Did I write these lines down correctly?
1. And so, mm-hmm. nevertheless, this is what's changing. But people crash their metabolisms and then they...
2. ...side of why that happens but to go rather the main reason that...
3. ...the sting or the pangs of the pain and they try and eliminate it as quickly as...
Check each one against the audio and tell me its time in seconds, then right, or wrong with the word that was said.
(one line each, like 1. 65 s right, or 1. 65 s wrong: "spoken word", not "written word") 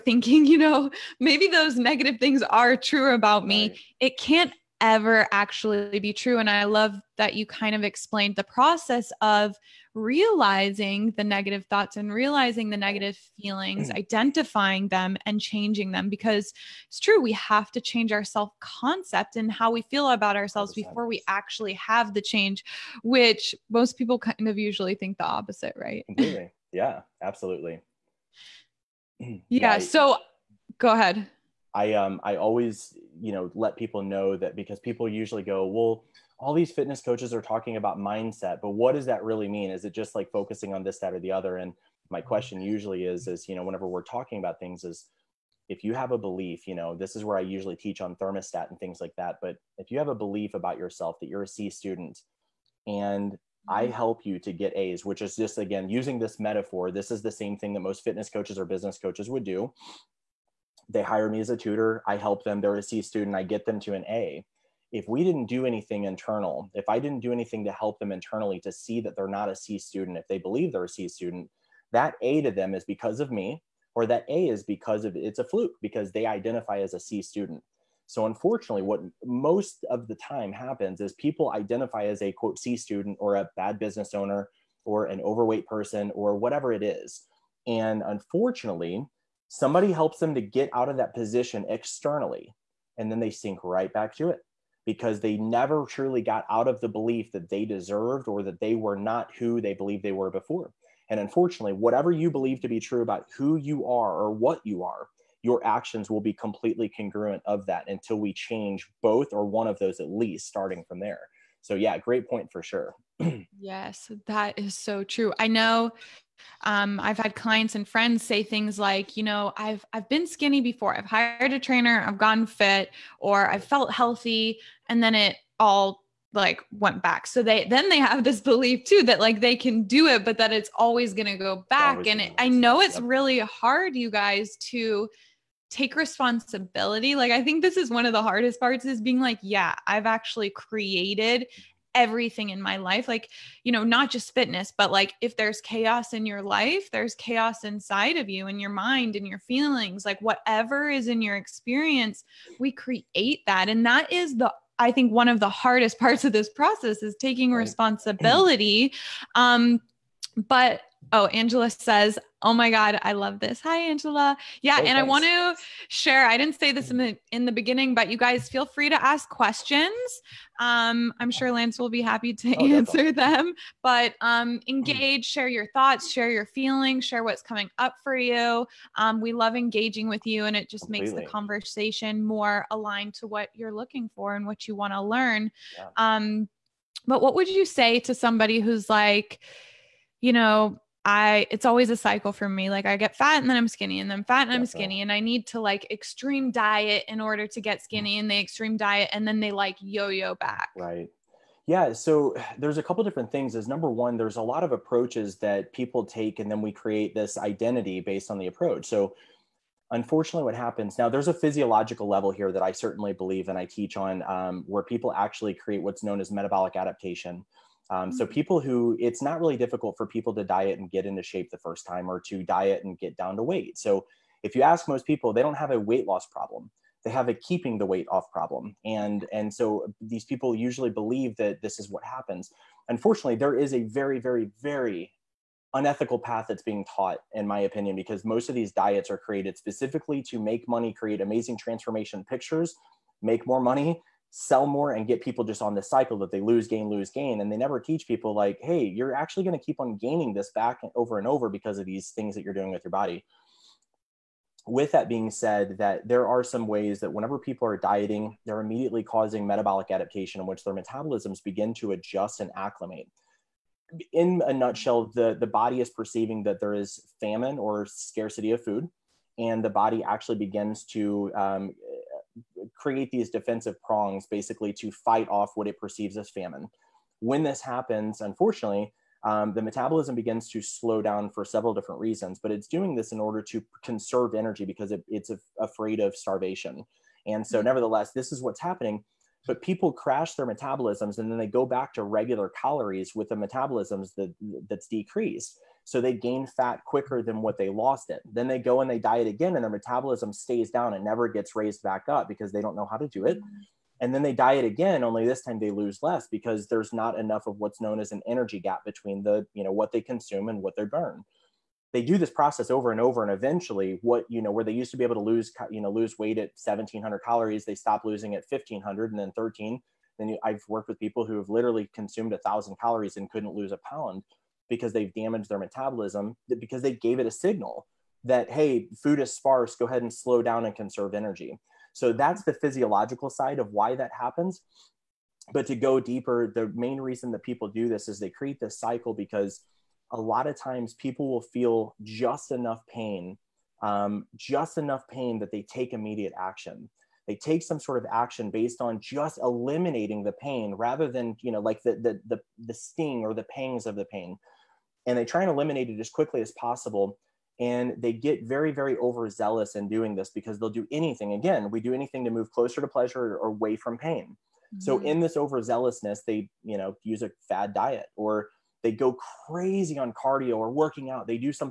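1. 287 s wrong: "happening", not "changing"
2. 333 s wrong: "deeper", not "rather"
3. 352 s right.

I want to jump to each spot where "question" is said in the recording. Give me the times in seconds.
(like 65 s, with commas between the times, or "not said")
42 s, 169 s.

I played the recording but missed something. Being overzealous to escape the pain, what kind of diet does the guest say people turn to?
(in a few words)
Fad diet.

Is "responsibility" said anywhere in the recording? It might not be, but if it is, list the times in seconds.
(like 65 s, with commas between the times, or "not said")
135 s, 157 s.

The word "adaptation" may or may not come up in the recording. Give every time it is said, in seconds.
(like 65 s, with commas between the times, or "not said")
216 s, 259 s.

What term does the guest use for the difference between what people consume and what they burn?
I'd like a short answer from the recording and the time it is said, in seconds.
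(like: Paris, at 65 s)
Energy gap, at 308 s.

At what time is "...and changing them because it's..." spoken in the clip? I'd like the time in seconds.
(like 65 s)
15 s.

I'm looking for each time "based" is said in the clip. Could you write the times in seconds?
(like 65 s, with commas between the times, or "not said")
208 s, 348 s.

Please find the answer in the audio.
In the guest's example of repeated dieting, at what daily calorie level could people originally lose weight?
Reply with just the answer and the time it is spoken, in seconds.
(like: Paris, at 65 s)
1700, at 316 s.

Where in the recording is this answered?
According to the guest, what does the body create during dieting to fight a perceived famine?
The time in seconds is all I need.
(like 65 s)
273 s.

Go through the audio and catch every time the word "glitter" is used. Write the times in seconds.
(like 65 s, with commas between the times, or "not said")
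not said.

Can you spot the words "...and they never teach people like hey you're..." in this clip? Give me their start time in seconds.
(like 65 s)
247 s.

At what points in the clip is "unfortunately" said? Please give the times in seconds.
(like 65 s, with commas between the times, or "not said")
78 s, 88 s, 101 s, 209 s, 232 s, 278 s.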